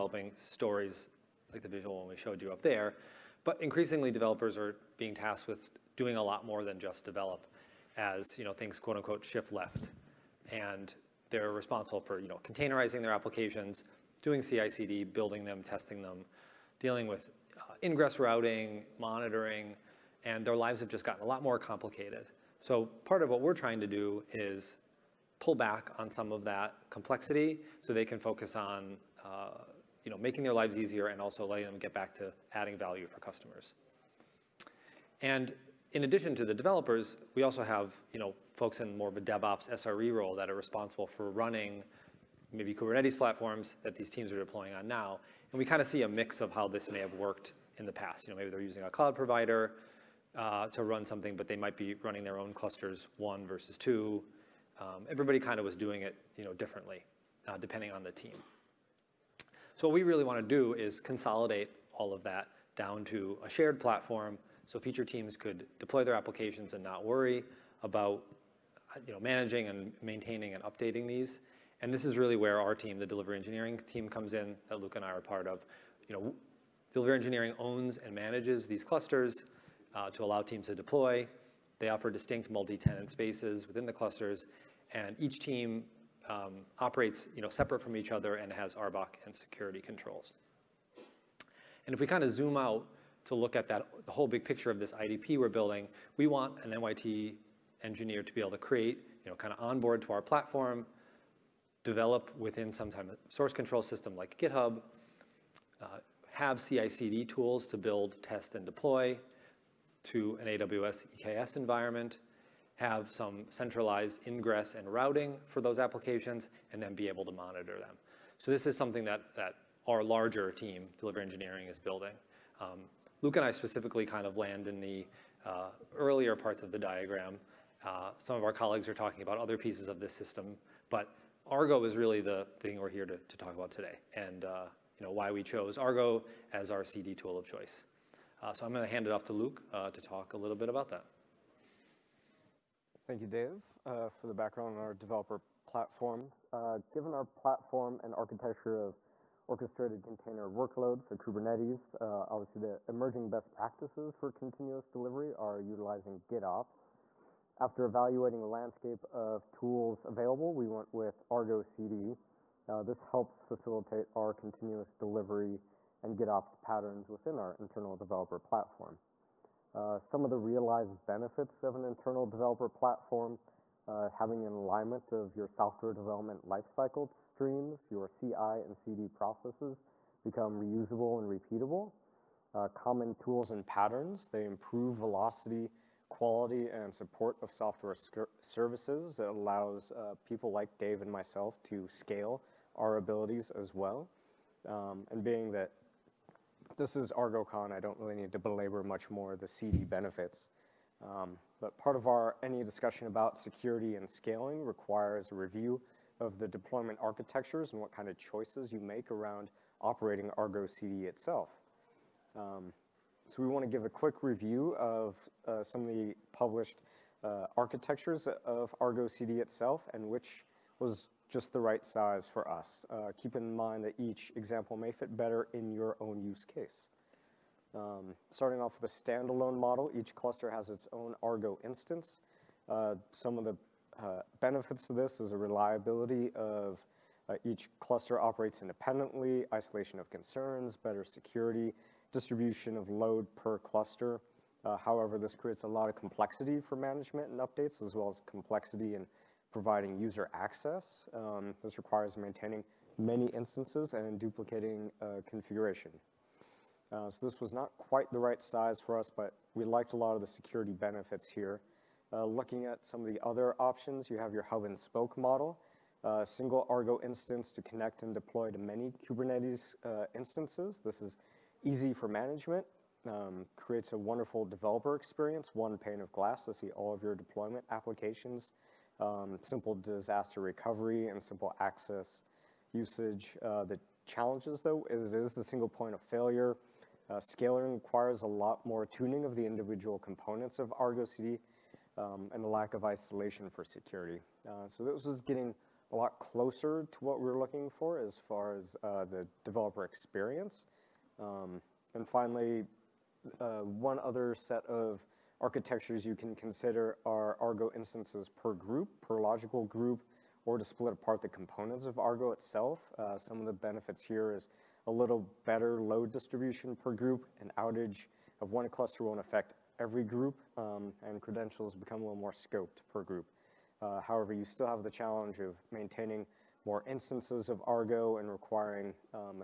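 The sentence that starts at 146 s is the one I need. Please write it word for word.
given our platform and architecture of orchestrated container workloads, or Kubernetes.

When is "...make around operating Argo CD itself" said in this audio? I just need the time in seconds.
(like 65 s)
208 s.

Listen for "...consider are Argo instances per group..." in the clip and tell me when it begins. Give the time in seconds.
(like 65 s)
306 s.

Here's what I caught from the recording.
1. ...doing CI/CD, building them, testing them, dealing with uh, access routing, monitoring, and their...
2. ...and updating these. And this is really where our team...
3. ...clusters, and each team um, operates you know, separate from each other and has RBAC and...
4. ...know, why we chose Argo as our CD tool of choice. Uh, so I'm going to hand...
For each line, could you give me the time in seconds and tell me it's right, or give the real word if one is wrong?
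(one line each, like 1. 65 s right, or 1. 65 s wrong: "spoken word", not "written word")
1. 14 s wrong: "ingress", not "access"
2. 70 s right
3. 83 s right
4. 135 s right.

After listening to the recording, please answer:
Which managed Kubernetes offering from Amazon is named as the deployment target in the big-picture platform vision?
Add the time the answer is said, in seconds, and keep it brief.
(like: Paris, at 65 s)
AWS EKS, at 110 s.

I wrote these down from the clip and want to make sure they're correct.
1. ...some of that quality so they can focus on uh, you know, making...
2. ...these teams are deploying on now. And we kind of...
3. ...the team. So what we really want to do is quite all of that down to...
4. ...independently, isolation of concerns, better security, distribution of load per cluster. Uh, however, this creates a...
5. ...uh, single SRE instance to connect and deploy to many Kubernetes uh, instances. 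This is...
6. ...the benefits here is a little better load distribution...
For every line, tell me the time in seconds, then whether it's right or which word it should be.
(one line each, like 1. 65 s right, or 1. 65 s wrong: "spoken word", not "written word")
1. 26 s wrong: "complexity", not "quality"
2. 43 s right
3. 58 s wrong: "consolidate", not "quite"
4. 238 s right
5. 266 s wrong: "Argo", not "SRE"
6. 313 s right.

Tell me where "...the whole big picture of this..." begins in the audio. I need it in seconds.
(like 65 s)
94 s.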